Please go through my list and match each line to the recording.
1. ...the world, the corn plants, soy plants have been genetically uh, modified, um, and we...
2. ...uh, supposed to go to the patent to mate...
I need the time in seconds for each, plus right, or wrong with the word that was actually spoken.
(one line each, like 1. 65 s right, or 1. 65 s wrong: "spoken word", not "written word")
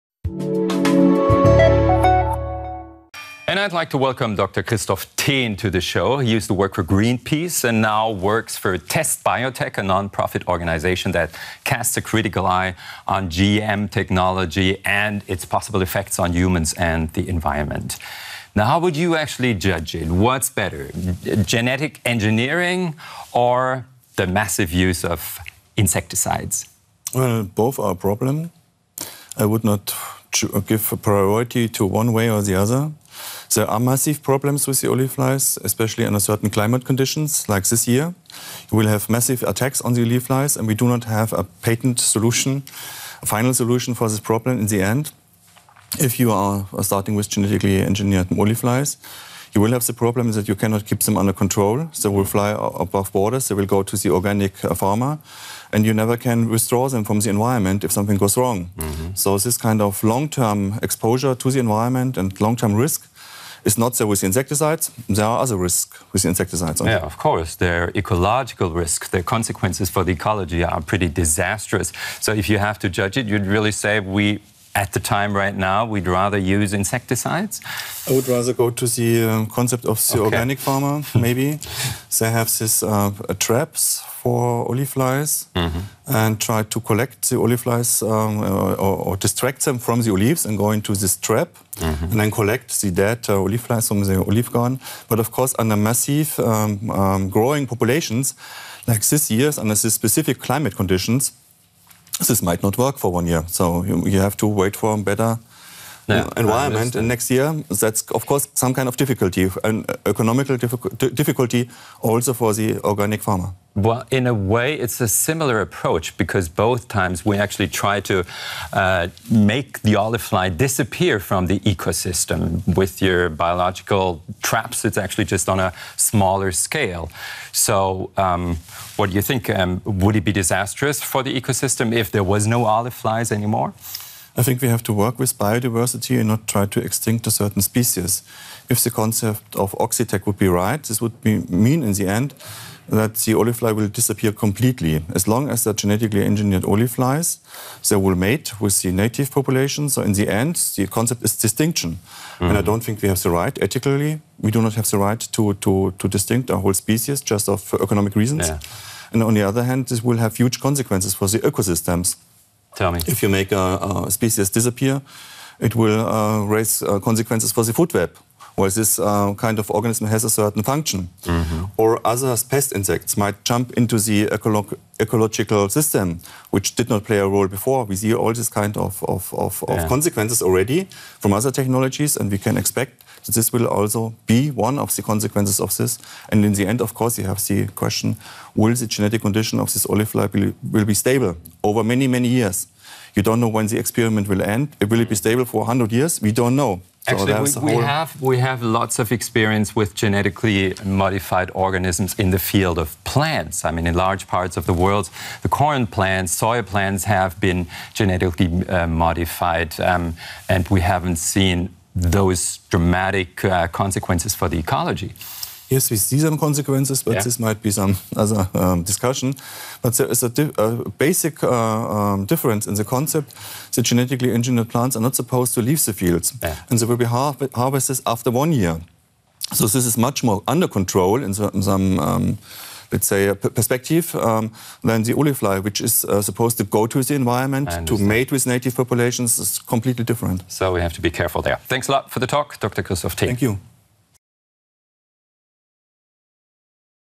1. 204 s right
2. 236 s wrong: "environment", not "patent".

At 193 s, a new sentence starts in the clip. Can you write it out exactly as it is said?
You don't know when the experiment will end.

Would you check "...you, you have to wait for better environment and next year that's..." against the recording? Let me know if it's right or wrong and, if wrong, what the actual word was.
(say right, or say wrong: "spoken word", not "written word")
right.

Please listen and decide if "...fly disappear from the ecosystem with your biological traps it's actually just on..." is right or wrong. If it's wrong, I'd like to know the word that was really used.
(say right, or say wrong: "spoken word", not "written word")
right.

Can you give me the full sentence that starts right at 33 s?
There are massive problems with the olive flies, especially under certain climate conditions, like this year.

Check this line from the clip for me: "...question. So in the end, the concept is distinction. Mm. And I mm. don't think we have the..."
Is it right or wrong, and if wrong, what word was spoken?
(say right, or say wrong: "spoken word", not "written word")
wrong: "population", not "question".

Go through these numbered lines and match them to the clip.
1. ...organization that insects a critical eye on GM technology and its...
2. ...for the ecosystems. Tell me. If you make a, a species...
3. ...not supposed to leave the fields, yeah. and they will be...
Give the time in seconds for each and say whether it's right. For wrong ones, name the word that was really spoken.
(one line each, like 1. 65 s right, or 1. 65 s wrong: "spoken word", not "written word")
1. 10 s wrong: "casts", not "insects"
2. 161 s right
3. 225 s right.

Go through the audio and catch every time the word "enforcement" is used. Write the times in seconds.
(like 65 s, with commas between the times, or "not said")
not said.